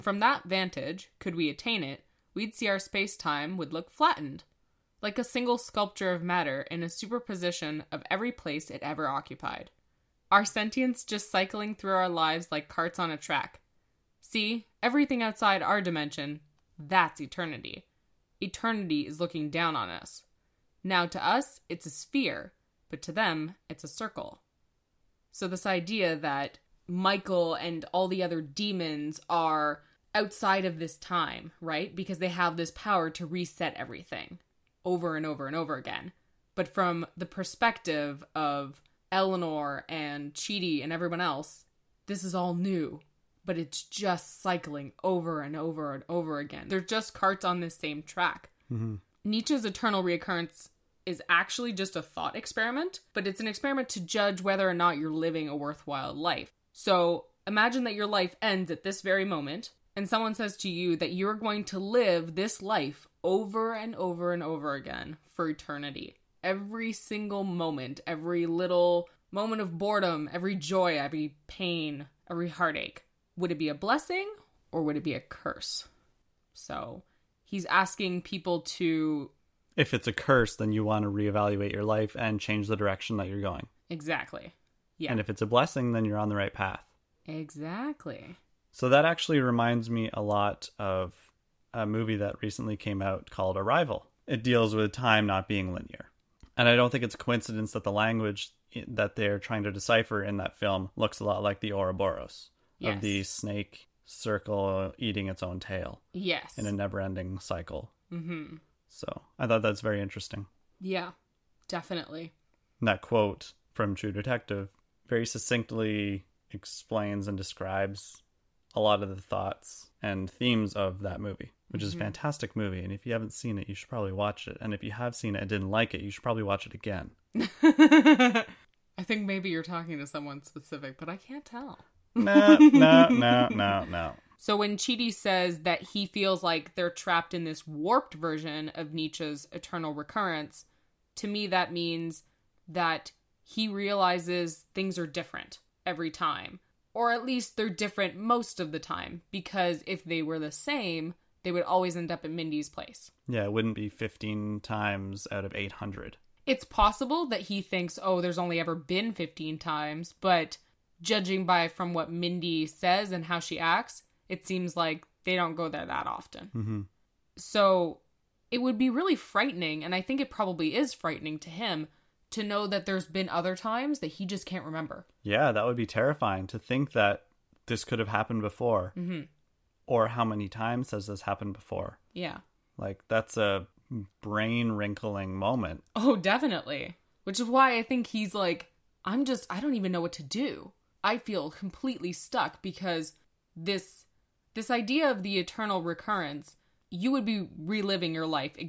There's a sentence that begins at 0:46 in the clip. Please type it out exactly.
They're just carts on this same track.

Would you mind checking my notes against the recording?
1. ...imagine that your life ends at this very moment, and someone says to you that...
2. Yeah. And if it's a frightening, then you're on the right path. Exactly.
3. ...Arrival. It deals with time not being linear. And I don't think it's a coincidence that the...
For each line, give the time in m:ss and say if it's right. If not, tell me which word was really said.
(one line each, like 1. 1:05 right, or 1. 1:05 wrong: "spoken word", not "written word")
1. 0:57 right
2. 1:24 wrong: "blessing", not "frightening"
3. 1:33 right.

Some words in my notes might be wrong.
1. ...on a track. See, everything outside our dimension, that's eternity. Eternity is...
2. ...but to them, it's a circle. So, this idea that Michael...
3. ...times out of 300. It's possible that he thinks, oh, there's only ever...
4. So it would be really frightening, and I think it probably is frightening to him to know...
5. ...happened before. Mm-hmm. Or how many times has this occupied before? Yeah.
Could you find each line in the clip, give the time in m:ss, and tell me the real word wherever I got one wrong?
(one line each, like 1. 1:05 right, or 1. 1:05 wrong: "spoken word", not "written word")
1. 0:13 right
2. 0:22 right
3. 2:34 wrong: "800", not "300"
4. 2:47 right
5. 2:58 wrong: "happened", not "occupied".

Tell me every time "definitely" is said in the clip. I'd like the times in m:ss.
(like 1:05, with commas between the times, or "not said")
1:51, 3:06.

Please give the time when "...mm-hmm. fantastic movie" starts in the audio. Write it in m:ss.
2:01.